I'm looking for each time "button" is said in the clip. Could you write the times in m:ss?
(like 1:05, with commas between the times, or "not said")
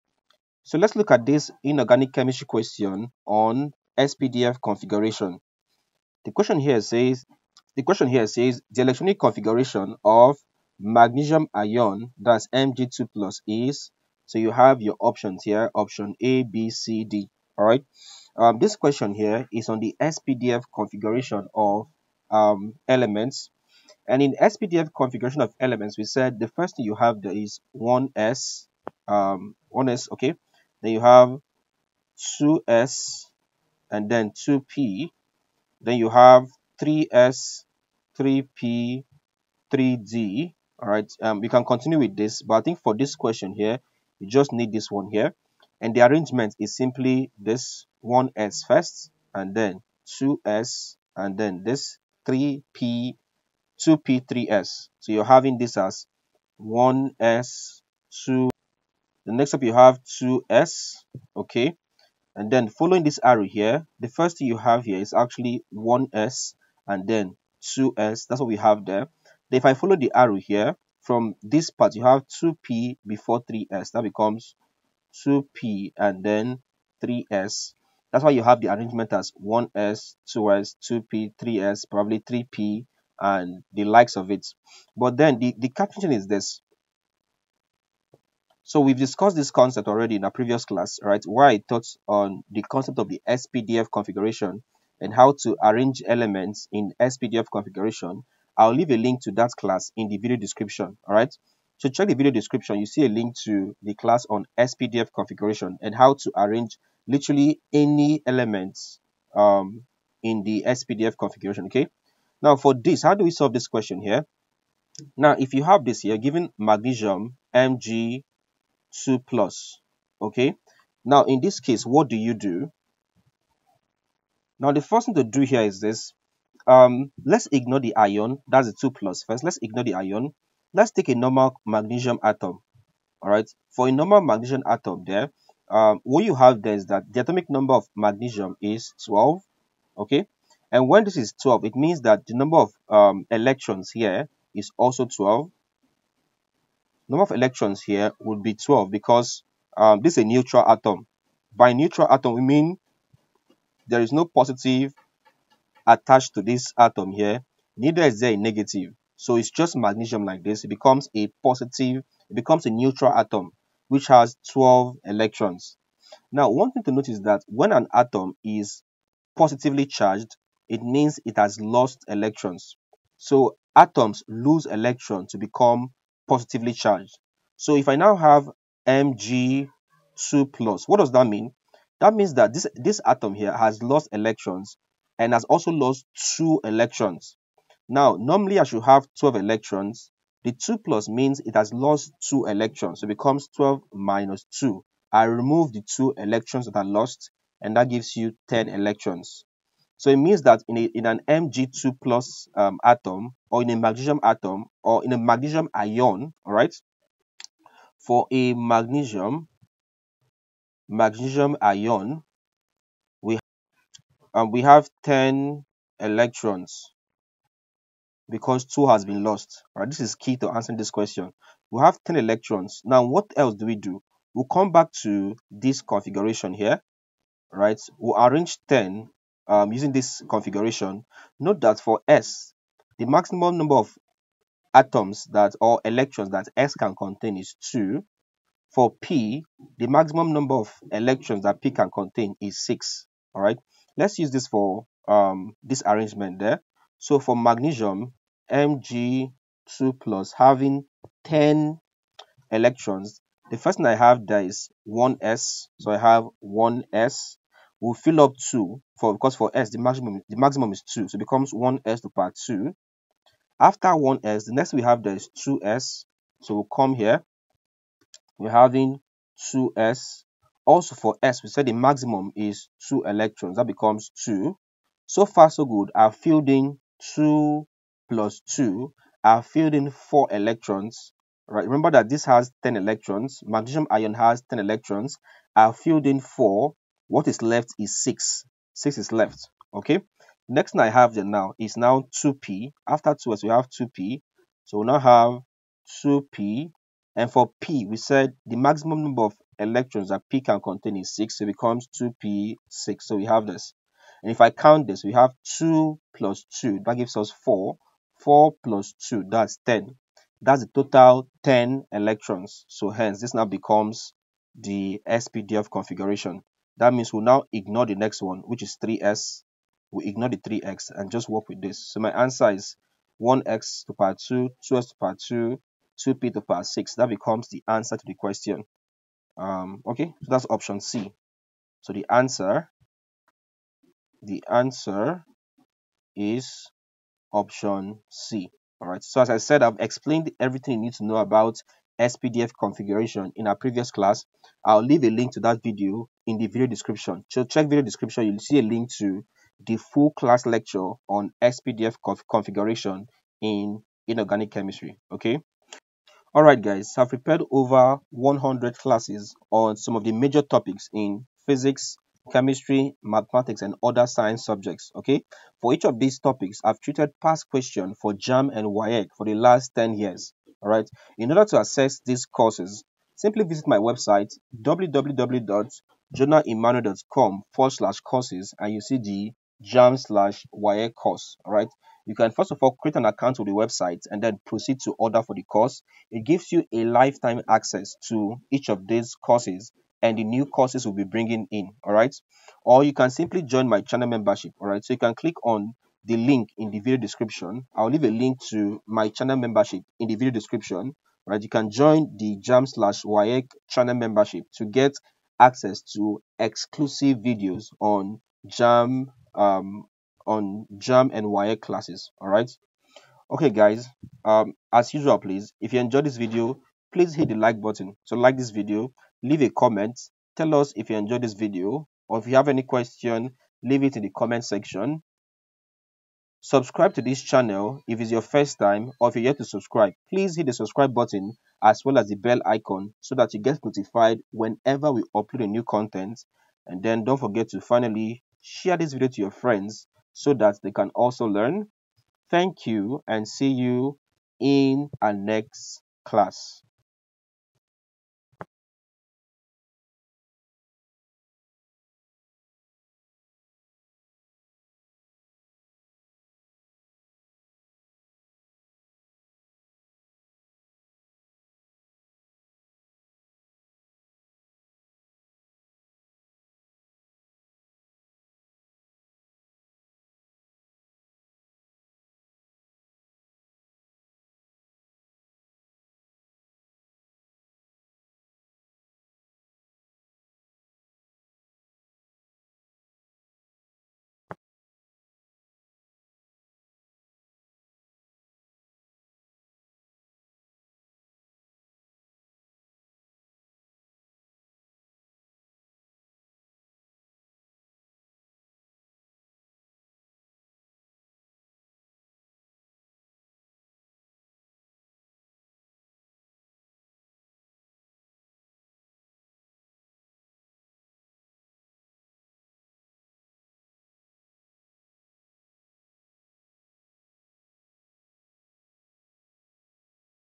6:57, 7:10.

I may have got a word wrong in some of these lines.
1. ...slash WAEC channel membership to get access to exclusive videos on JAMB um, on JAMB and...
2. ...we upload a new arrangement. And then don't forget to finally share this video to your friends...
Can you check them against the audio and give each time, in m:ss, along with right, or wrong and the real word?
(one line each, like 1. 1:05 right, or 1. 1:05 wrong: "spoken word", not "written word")
1. 6:42 right
2. 7:14 wrong: "content", not "arrangement".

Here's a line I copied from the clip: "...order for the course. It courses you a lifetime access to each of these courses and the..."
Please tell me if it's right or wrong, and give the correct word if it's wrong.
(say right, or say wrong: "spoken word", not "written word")
wrong: "gives", not "courses".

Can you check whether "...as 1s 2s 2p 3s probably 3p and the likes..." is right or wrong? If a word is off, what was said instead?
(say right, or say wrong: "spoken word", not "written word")
right.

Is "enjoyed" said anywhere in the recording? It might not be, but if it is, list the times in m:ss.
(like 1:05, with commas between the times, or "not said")
6:55, 7:00.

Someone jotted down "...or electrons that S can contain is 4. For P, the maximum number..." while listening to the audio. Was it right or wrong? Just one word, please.
wrong.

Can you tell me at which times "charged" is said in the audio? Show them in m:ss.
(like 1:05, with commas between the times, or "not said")
2:49, 2:56.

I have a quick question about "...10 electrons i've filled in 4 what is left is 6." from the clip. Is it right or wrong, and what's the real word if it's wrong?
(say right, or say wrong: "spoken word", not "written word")
right.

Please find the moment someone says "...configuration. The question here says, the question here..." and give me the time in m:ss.
0:04.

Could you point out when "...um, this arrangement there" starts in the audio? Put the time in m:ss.
4:05.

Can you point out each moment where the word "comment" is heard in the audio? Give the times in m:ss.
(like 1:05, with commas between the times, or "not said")
6:59, 7:04.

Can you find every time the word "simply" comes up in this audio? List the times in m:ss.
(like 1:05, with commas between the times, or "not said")
0:46, 6:13, 6:33.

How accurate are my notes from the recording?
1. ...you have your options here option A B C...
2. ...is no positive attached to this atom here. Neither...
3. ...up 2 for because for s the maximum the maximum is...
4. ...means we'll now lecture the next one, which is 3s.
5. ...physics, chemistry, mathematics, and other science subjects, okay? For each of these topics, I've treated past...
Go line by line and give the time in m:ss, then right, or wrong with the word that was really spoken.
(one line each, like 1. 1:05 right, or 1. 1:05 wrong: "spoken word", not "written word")
1. 0:14 right
2. 2:34 right
3. 4:18 right
4. 5:16 wrong: "ignore", not "lecture"
5. 6:01 right.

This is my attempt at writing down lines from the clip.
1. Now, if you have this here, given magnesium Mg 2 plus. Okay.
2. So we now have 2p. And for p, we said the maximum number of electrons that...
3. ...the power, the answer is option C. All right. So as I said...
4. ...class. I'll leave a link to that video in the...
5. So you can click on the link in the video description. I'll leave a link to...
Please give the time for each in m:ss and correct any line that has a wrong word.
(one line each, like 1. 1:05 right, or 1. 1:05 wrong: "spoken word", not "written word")
1. 1:55 right
2. 4:54 right
3. 5:31 wrong: "answer", not "power"
4. 5:43 right
5. 6:34 right.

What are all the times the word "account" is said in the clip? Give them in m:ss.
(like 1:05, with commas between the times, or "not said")
6:23.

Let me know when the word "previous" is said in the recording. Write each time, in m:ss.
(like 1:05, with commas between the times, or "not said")
1:30, 5:43.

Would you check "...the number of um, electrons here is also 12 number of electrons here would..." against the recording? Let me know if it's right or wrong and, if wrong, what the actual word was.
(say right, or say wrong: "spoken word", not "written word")
right.